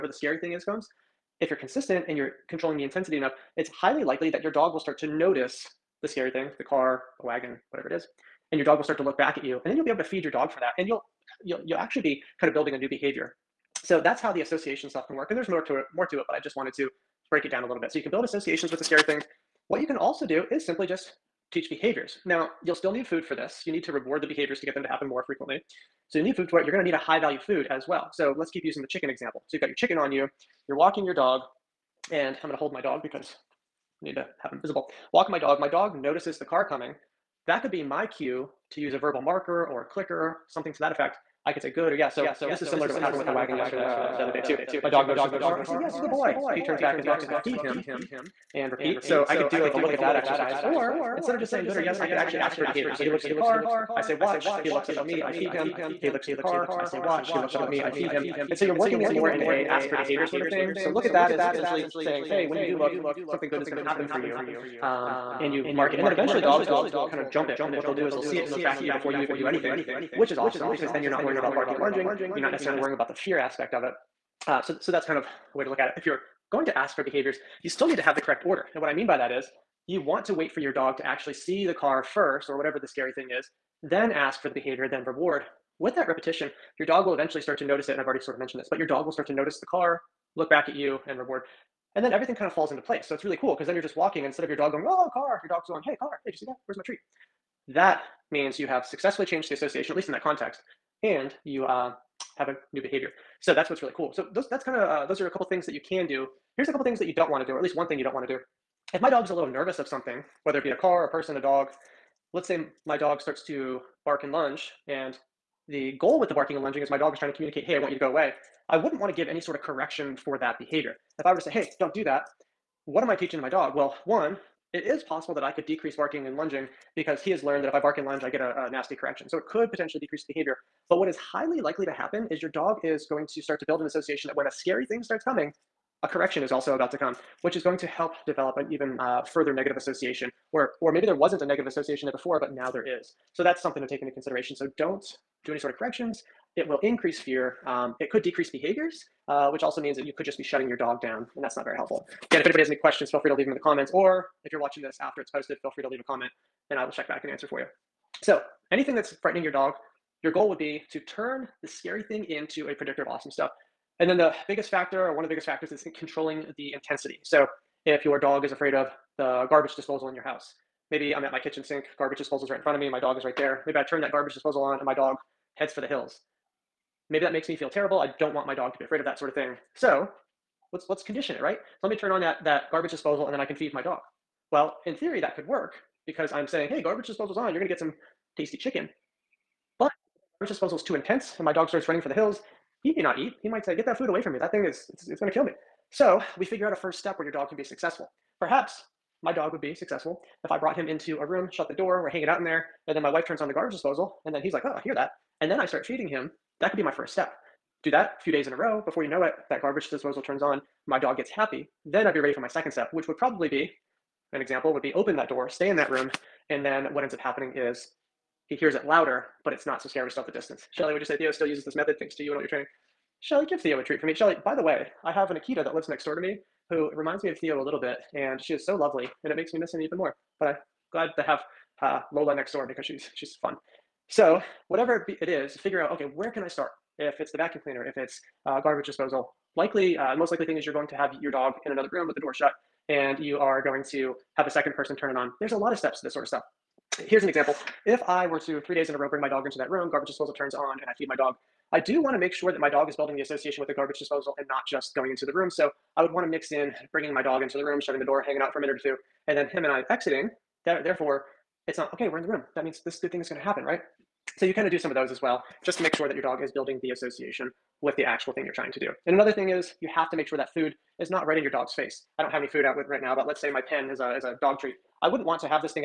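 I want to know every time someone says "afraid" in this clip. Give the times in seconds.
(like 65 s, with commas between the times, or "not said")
168 s, 178 s.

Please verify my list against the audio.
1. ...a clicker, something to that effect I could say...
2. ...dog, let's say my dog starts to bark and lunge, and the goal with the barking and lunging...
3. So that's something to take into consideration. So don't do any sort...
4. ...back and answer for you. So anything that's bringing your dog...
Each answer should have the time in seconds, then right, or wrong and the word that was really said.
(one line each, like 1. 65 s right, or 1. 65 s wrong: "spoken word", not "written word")
1. 39 s right
2. 111 s right
3. 143 s right
4. 157 s wrong: "frightening", not "bringing".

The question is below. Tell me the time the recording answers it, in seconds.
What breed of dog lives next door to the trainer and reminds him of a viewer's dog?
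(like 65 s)
225 s.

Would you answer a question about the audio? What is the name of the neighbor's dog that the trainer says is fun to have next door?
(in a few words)
Lola.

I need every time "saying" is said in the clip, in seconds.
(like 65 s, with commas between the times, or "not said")
51 s, 61 s, 186 s.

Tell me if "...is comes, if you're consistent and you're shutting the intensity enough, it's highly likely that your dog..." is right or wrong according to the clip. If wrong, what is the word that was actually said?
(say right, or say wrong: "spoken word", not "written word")
wrong: "controlling", not "shutting".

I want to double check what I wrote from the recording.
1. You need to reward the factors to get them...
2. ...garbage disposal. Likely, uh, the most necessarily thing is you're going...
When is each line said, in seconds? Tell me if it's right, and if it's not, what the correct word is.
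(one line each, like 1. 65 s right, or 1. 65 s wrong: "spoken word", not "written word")
1. 23 s wrong: "behaviors", not "factors"
2. 238 s wrong: "likely", not "necessarily".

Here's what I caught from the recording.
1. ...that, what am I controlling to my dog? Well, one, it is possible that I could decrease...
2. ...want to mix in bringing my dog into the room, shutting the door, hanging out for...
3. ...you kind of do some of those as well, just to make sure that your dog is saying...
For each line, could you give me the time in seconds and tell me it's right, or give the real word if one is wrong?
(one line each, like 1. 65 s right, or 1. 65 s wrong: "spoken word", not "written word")
1. 122 s wrong: "teaching", not "controlling"
2. 256 s right
3. 264 s wrong: "building", not "saying".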